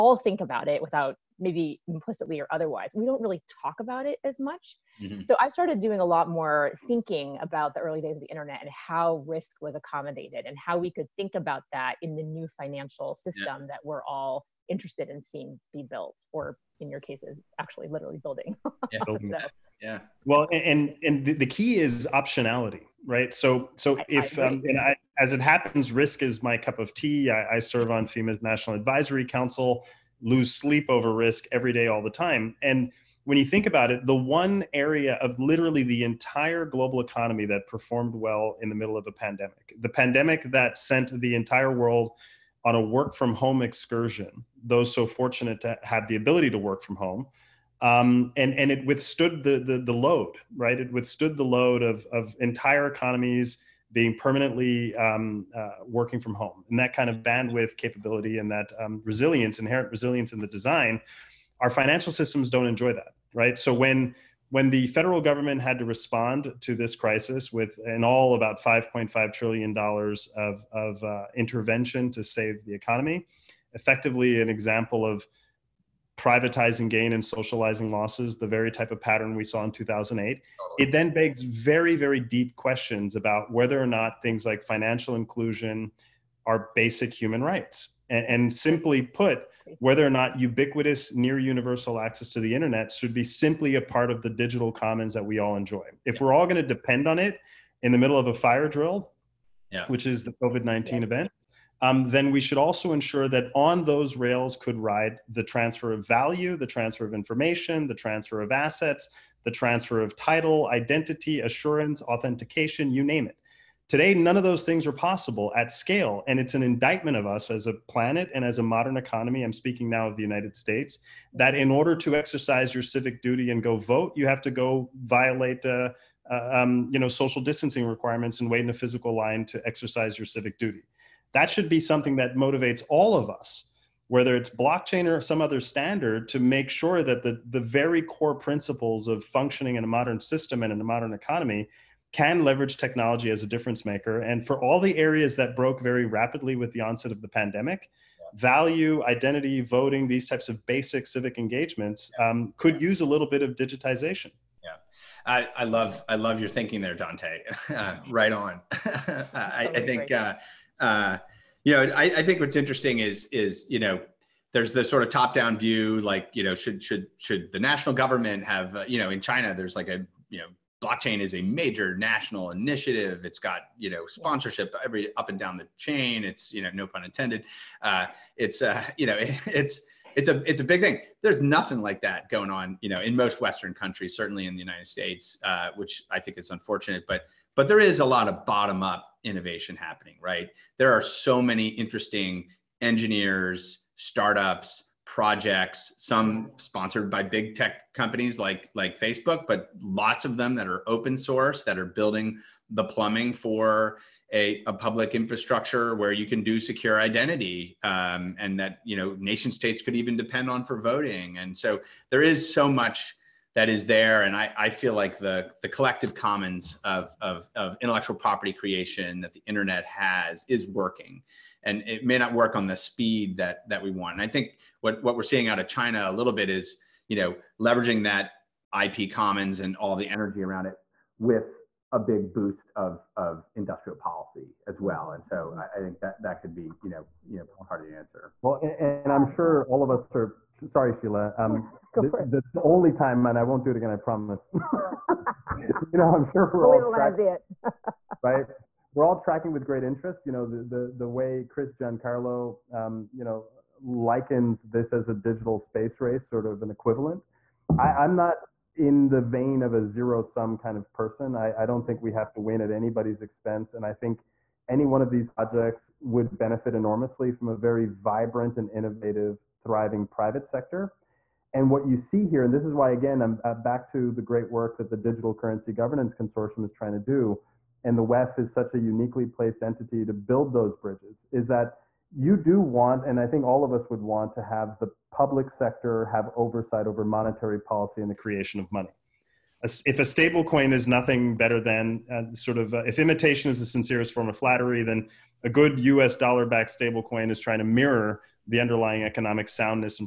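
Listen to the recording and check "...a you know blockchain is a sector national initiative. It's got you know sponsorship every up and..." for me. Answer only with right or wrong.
wrong.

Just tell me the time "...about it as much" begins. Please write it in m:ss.
0:03.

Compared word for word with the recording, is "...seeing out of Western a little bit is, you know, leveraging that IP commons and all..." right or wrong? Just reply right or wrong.
wrong.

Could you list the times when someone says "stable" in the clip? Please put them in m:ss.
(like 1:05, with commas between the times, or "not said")
4:50, 4:56.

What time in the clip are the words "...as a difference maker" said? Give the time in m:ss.
2:23.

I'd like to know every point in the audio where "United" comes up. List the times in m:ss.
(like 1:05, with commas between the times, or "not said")
2:00, 3:04.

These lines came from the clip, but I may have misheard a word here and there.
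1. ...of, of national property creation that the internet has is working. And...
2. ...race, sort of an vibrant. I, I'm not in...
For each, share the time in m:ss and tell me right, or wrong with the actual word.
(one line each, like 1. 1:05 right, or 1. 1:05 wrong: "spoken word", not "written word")
1. 3:37 wrong: "intellectual", not "national"
2. 4:16 wrong: "equivalent", not "vibrant".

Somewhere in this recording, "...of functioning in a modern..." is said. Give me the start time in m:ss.
2:19.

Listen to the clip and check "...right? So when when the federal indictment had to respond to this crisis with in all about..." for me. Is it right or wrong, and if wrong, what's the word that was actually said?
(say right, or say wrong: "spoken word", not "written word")
wrong: "government", not "indictment".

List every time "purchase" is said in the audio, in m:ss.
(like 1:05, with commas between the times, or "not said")
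not said.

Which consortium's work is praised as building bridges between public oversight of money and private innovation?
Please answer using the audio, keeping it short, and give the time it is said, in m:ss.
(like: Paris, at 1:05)
Digital Currency Governance Consortium, at 4:34.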